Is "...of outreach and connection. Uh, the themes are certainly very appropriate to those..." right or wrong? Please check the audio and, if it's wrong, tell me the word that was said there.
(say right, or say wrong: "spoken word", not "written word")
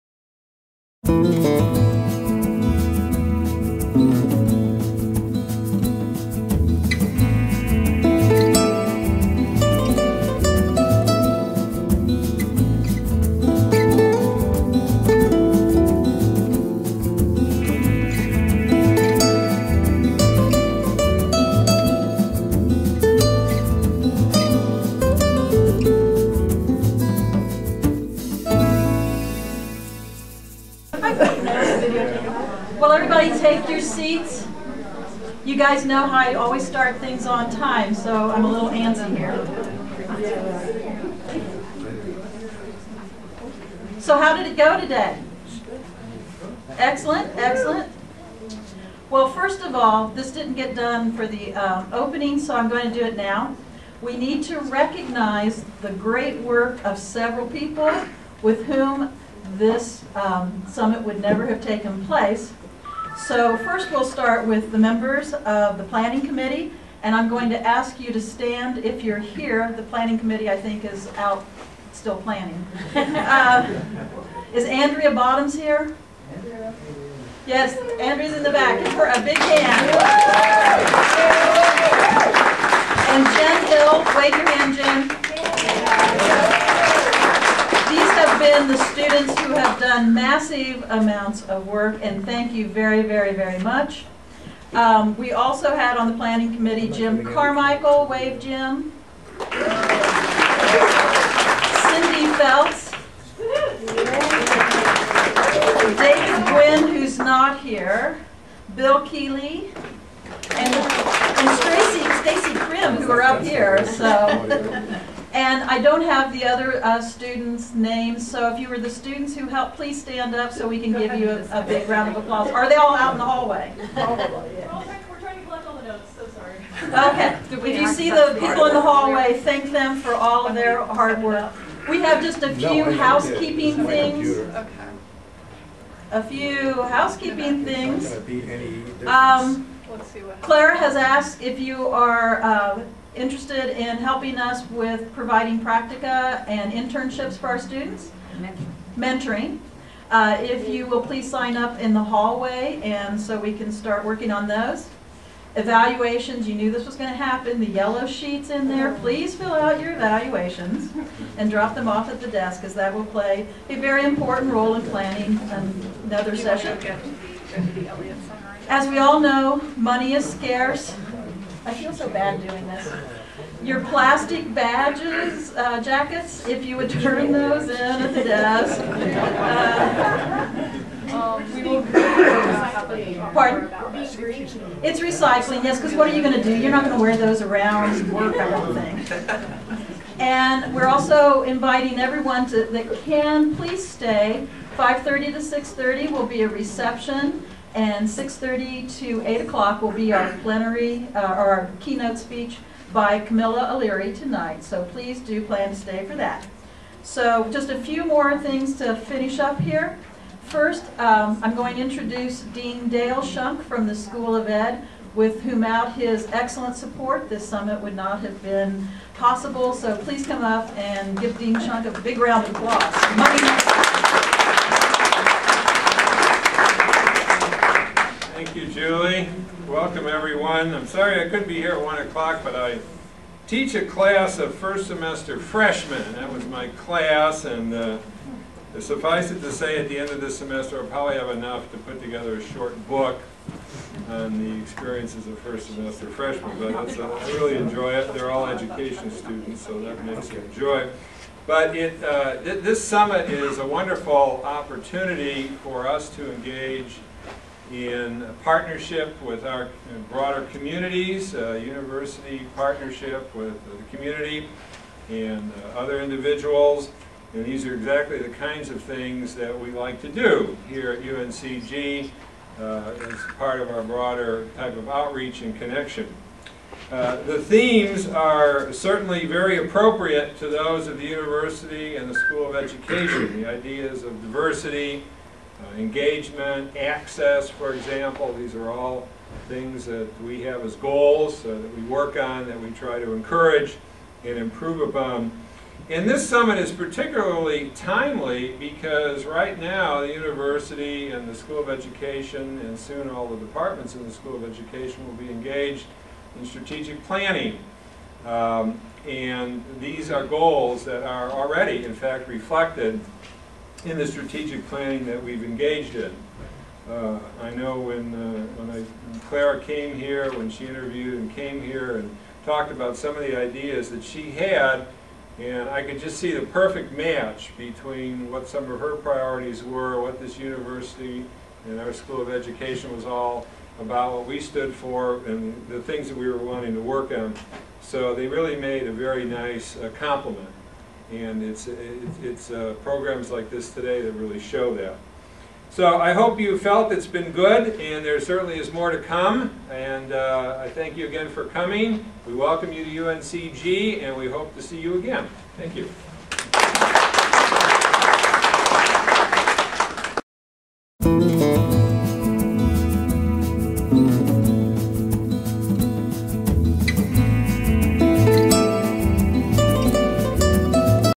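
right.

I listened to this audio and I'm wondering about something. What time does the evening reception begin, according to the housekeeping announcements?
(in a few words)
5:30.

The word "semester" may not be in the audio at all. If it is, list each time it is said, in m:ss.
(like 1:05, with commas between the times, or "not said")
3:54, 4:00, 4:05.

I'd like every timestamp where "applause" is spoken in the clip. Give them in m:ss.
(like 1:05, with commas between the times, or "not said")
2:02, 3:42.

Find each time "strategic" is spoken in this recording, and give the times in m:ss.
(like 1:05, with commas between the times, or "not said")
5:06, 5:14.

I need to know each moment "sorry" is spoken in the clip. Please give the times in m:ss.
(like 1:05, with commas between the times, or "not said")
2:06, 3:50.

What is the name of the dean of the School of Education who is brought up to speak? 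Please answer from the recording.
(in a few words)
Dale Schunk.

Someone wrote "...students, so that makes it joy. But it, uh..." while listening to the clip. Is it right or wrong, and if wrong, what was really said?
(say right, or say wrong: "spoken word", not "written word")
right.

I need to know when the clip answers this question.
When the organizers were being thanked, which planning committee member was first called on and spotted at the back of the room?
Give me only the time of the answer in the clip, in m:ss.
1:14.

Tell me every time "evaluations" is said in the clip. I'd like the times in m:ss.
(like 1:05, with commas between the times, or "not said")
2:35, 2:39.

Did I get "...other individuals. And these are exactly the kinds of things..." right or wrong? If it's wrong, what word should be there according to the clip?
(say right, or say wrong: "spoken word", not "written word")
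right.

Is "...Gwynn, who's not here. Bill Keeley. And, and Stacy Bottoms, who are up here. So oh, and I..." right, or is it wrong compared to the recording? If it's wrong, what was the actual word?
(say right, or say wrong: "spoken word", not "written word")
wrong: "Prim", not "Bottoms".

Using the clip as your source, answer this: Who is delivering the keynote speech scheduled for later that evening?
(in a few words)
Camila Alire.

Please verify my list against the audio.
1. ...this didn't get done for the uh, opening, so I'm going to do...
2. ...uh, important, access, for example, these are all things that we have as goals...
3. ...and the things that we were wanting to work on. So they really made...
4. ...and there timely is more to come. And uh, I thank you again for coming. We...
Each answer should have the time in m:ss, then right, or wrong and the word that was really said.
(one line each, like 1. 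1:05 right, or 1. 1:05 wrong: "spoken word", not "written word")
1. 0:50 right
2. 4:45 wrong: "engagement", not "important"
3. 5:35 right
4. 5:47 wrong: "certainly", not "timely".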